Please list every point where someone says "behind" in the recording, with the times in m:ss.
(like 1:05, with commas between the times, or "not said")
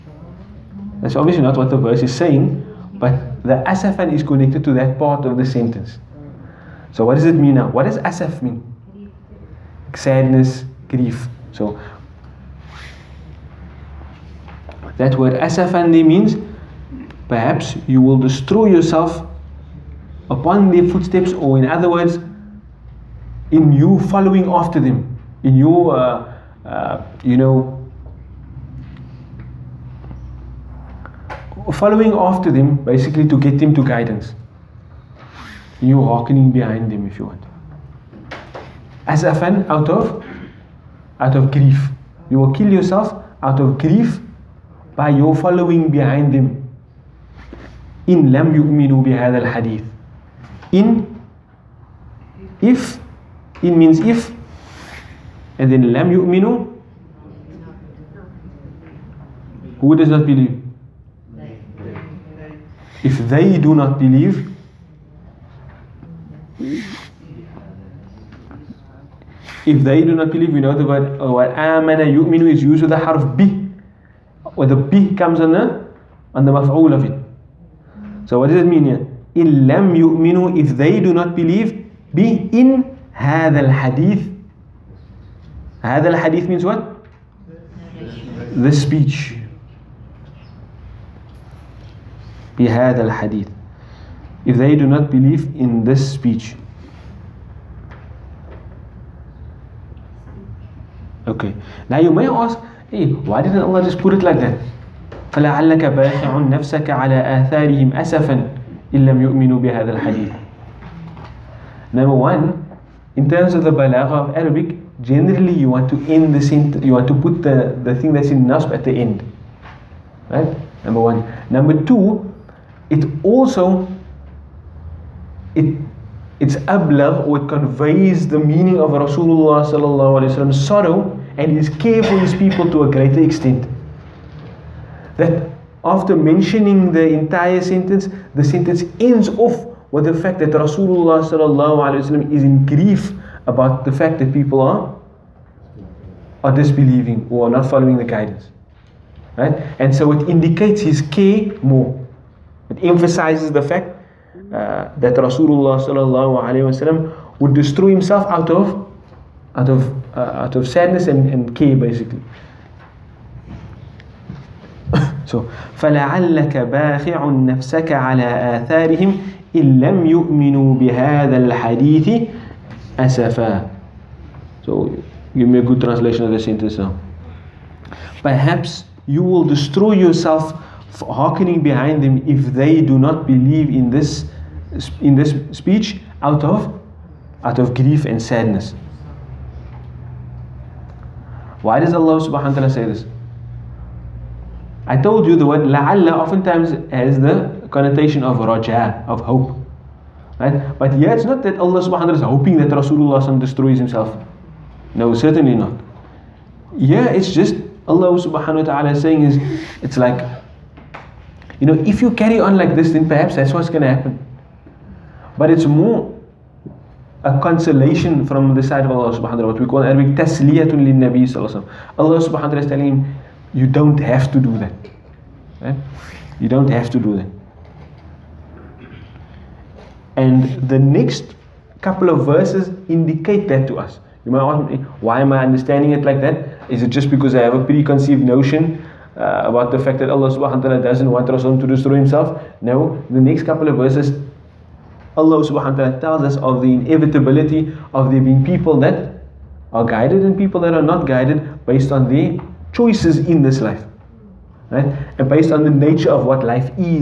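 0:36, 0:45, 3:01.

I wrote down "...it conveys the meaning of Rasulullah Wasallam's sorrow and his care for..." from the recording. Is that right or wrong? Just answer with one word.
right.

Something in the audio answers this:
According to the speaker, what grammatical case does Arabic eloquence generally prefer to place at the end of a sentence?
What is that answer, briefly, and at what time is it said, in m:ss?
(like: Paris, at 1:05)
nasb, at 1:58.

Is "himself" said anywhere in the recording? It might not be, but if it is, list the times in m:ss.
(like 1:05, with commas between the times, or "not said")
2:37, 3:23, 4:01.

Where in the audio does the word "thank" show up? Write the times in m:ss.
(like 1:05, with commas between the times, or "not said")
not said.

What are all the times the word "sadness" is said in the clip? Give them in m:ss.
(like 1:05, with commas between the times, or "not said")
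0:09, 2:40, 3:08.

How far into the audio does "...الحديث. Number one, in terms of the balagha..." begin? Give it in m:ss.
1:49.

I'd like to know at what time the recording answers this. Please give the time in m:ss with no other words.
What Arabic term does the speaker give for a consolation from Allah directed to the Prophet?
3:40.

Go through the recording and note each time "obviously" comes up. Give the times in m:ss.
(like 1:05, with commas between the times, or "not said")
0:01.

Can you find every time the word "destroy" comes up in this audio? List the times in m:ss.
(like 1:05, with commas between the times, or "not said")
0:18, 2:37, 2:59, 3:23, 4:01.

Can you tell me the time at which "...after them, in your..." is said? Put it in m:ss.
0:24.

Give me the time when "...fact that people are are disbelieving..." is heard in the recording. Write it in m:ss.
2:23.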